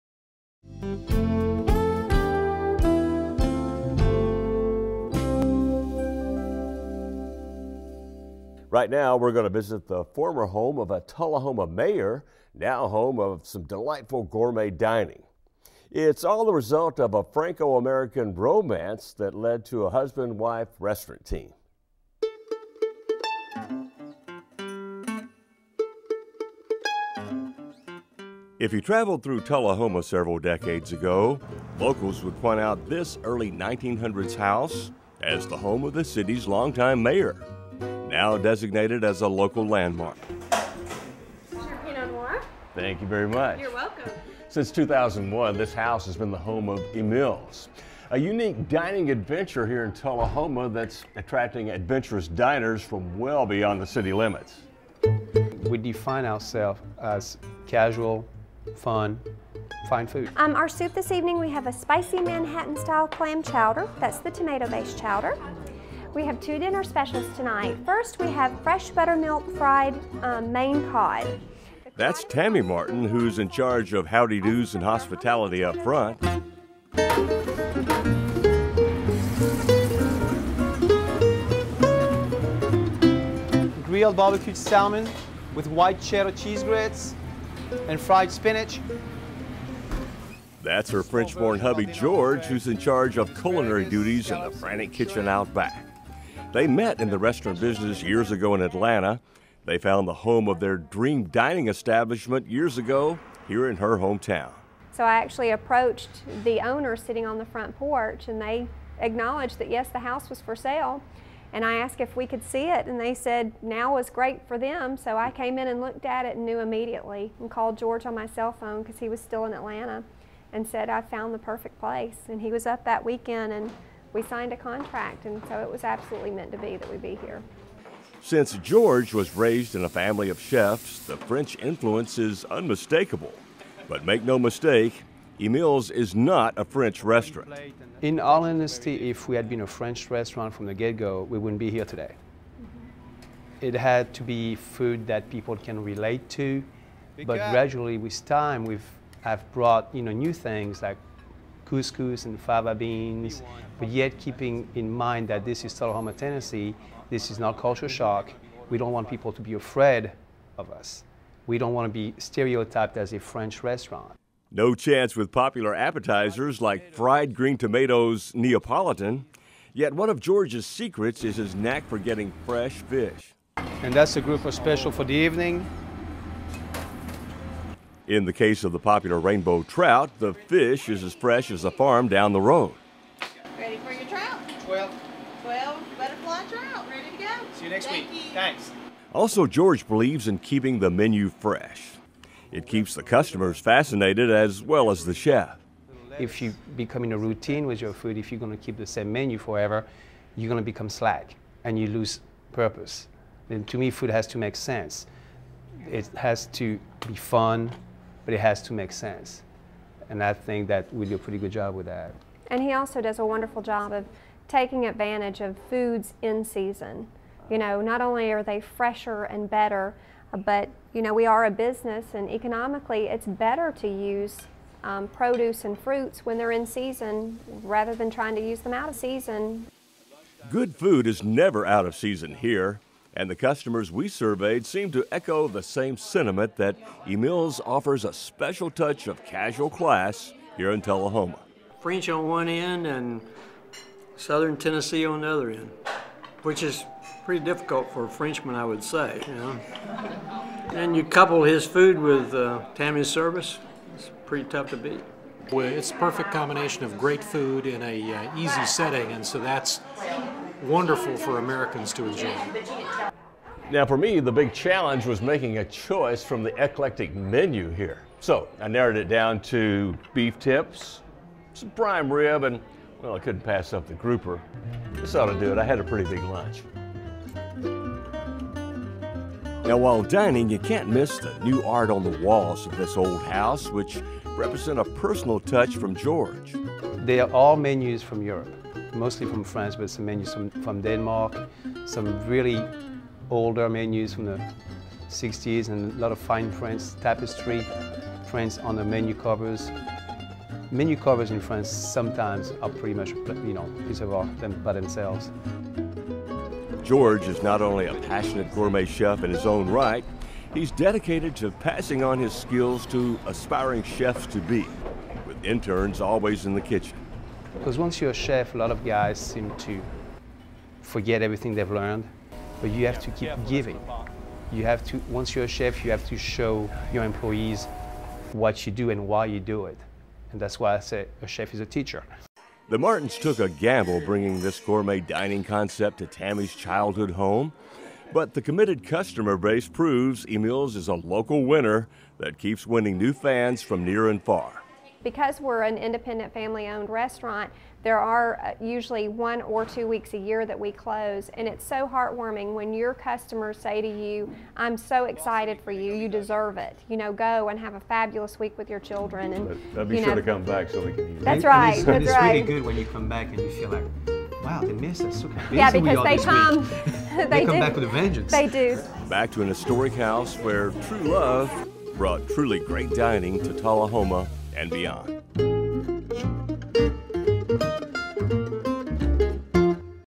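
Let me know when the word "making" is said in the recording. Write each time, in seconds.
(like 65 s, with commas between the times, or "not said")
265 s.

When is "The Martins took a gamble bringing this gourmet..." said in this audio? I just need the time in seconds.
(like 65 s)
332 s.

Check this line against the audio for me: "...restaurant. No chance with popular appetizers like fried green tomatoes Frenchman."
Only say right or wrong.
wrong.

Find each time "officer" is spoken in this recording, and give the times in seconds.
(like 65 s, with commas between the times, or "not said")
not said.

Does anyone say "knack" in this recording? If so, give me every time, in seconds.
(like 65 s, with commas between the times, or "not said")
171 s.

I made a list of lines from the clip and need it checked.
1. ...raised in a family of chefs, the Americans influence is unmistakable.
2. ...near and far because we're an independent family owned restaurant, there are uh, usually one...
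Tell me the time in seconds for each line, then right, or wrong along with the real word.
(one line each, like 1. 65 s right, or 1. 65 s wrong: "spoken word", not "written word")
1. 129 s wrong: "French", not "Americans"
2. 343 s right.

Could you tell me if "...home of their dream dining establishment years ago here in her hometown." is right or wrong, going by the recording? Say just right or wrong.
right.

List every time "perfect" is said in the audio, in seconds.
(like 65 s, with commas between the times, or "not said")
121 s, 255 s.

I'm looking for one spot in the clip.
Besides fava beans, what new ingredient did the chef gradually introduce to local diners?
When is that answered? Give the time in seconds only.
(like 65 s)
151 s.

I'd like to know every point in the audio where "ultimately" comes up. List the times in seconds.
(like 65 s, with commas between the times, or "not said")
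not said.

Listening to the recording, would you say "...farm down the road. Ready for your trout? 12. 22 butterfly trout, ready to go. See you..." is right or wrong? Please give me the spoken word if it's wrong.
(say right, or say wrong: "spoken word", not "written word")
wrong: "12", not "22".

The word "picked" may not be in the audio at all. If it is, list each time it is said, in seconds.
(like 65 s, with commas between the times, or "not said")
not said.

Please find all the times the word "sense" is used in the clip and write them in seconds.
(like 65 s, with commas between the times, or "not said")
204 s, 208 s.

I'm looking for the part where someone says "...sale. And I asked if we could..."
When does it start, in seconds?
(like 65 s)
110 s.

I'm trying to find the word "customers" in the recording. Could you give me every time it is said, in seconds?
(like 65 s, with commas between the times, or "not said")
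193 s, 233 s, 338 s, 352 s.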